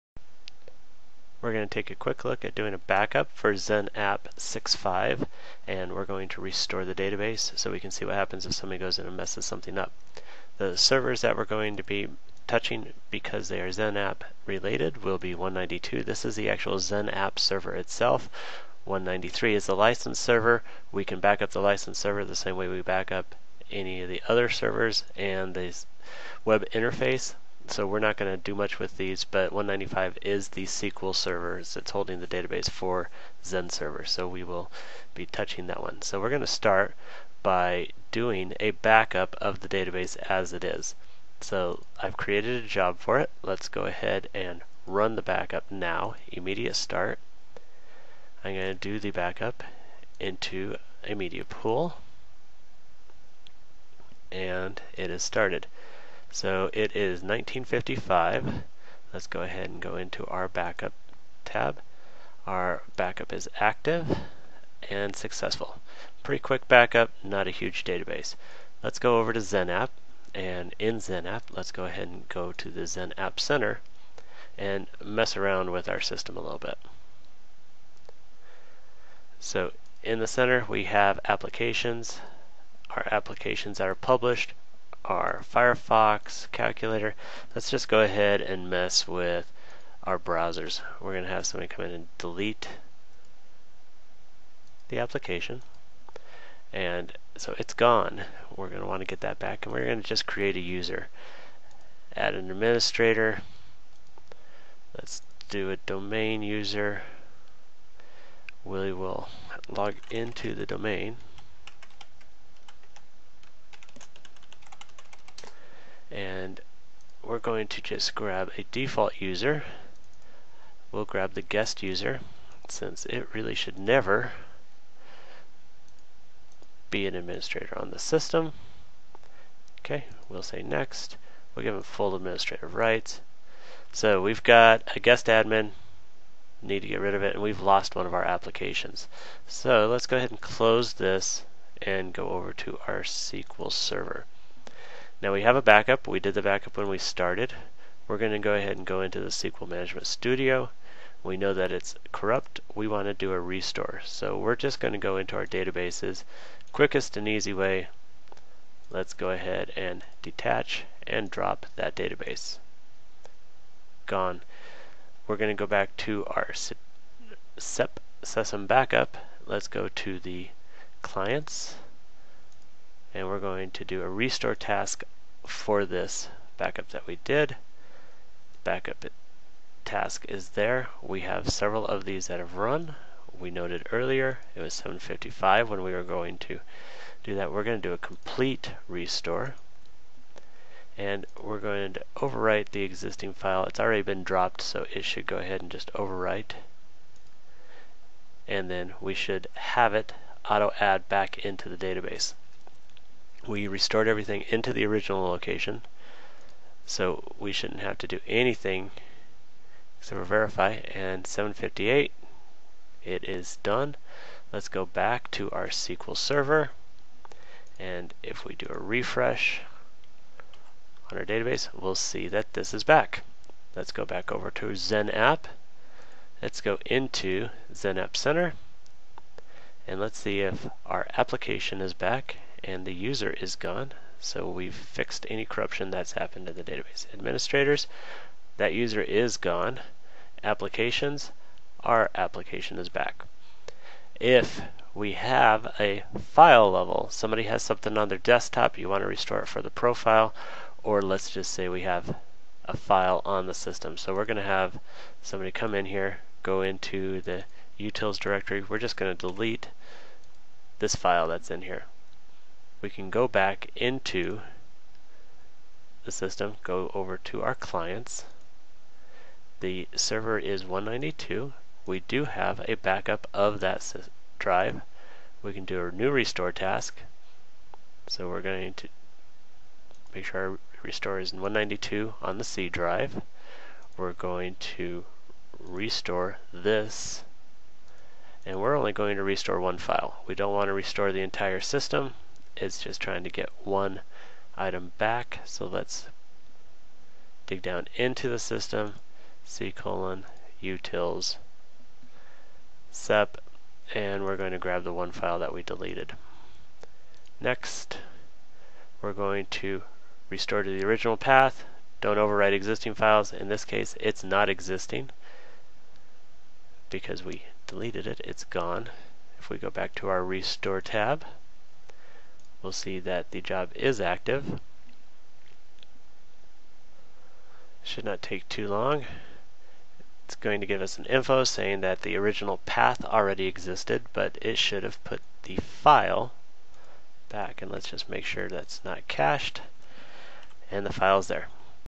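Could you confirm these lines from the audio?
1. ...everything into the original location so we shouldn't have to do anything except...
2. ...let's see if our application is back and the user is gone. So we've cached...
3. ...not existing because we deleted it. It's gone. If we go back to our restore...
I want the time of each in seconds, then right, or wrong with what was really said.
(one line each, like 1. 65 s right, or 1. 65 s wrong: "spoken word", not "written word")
1. 204 s right
2. 229 s wrong: "fixed", not "cached"
3. 314 s right.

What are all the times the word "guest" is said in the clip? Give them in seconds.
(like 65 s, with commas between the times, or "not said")
121 s, 134 s.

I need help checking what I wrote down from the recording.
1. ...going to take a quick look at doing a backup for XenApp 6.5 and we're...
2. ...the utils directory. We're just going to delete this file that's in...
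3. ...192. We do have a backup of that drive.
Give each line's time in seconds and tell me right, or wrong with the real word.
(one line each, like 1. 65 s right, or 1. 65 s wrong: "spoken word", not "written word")
1. 1 s right
2. 257 s right
3. 270 s right.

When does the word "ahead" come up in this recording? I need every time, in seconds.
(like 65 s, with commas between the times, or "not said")
43 s, 59 s, 71 s, 88 s, 140 s, 148 s, 159 s, 195 s.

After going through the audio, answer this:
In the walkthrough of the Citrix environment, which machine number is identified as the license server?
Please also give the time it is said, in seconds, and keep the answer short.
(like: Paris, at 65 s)
193, at 18 s.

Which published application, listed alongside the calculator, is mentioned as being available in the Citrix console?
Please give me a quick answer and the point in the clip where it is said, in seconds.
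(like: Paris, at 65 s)
Firefox, at 85 s.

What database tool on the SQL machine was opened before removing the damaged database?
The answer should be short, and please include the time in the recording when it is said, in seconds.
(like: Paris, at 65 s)
SQL Management Studio, at 149 s.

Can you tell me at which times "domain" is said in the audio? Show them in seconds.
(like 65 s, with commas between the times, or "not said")
105 s, 110 s.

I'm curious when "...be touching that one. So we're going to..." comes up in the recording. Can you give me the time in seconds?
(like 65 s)
35 s.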